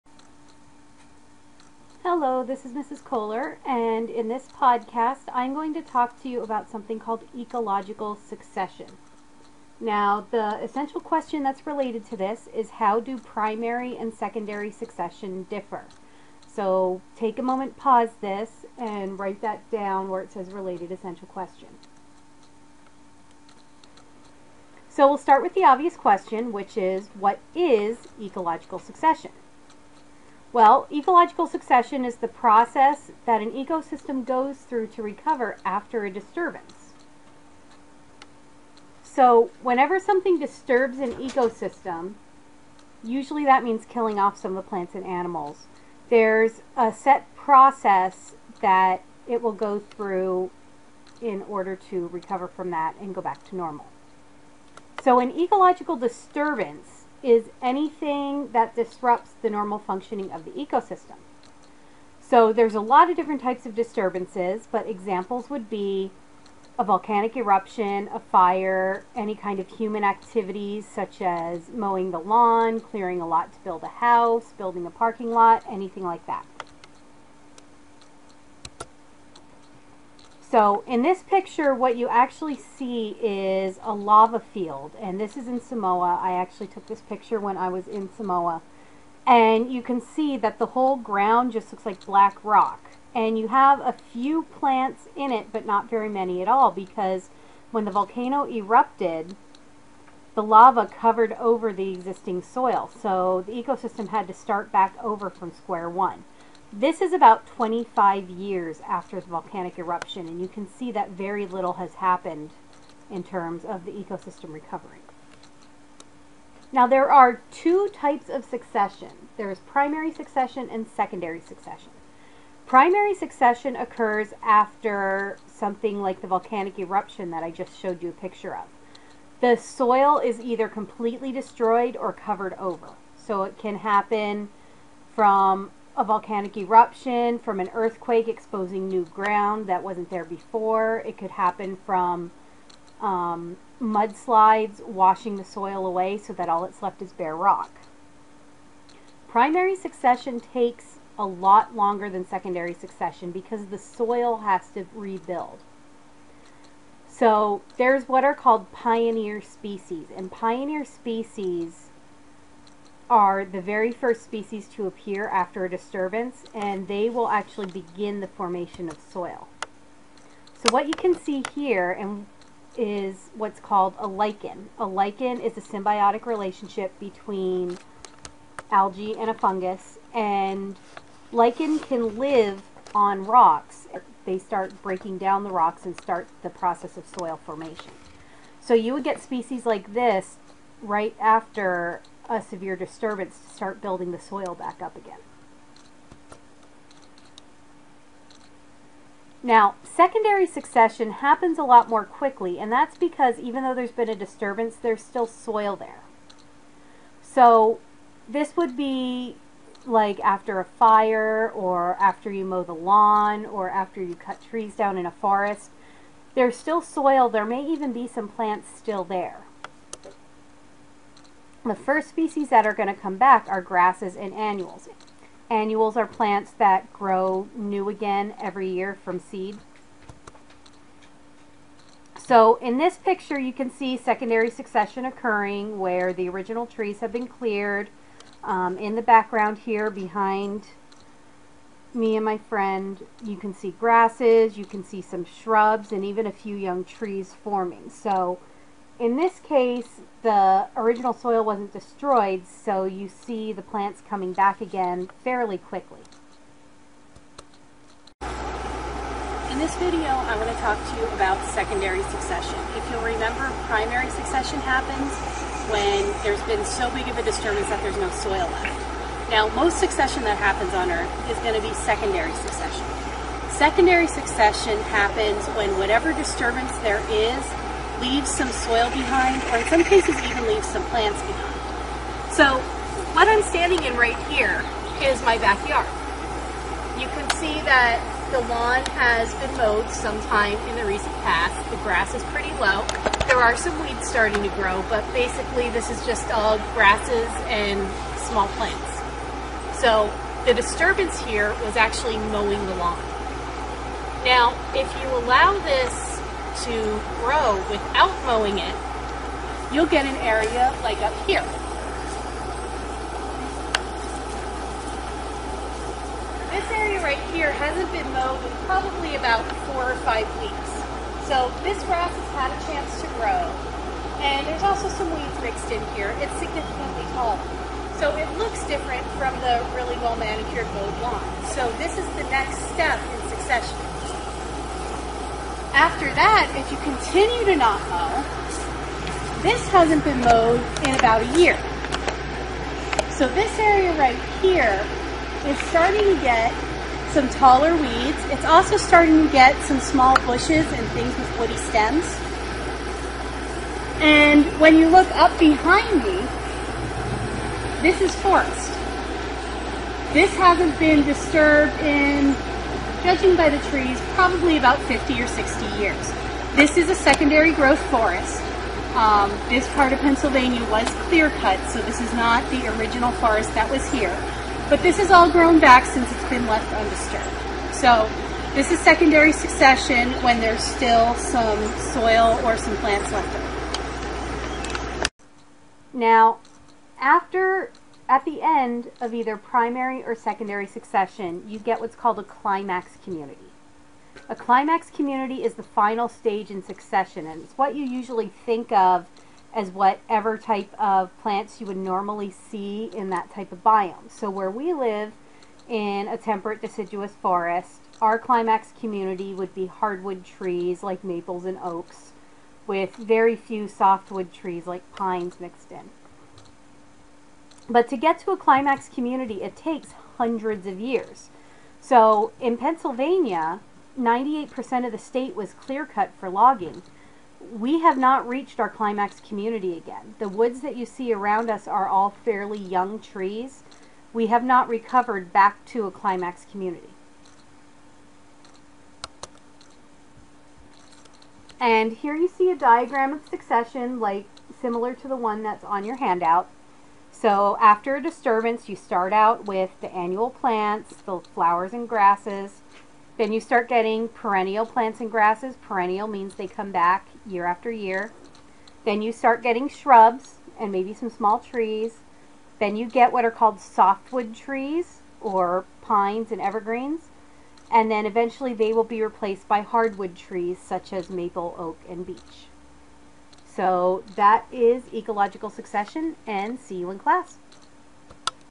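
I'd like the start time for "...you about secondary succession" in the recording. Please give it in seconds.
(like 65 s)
261 s.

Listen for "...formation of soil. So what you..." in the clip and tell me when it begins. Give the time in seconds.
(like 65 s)
168 s.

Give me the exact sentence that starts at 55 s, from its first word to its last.
So, an ecological disturbance is anything that disrupts the normal functioning of the ecosystem.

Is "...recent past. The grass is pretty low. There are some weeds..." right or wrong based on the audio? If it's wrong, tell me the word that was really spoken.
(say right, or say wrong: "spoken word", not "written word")
right.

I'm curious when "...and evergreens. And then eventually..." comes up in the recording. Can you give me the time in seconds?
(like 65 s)
466 s.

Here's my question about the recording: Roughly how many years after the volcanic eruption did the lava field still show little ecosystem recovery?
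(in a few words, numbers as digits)
25 years.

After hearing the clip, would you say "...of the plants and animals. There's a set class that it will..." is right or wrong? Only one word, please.
wrong.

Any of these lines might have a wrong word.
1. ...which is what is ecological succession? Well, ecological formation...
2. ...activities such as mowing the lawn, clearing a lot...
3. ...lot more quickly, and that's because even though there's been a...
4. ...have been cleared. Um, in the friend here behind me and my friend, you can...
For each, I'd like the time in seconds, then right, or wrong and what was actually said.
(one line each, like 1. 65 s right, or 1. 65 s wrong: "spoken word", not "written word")
1. 26 s wrong: "succession", not "formation"
2. 70 s right
3. 201 s right
4. 237 s wrong: "background", not "friend".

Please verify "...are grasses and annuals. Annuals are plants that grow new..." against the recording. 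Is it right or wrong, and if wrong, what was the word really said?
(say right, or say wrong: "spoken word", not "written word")
right.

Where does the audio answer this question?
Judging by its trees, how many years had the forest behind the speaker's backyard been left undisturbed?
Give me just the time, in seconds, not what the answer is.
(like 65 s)
364 s.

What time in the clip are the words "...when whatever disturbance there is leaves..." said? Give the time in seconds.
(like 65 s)
275 s.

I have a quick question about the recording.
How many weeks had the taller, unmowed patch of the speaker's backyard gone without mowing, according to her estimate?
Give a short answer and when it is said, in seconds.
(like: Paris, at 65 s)
4 or 5 weeks, at 319 s.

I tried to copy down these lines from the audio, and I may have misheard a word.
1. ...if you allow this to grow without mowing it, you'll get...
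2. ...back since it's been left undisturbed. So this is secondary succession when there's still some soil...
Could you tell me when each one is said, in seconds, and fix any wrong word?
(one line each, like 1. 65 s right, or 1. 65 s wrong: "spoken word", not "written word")
1. 304 s right
2. 375 s right.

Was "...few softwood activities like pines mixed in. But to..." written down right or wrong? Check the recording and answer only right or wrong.
wrong.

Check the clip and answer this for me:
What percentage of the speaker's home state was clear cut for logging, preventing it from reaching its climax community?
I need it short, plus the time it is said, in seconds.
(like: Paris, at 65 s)
98%, at 423 s.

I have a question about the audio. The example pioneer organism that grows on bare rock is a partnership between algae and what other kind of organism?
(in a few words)
a fungus.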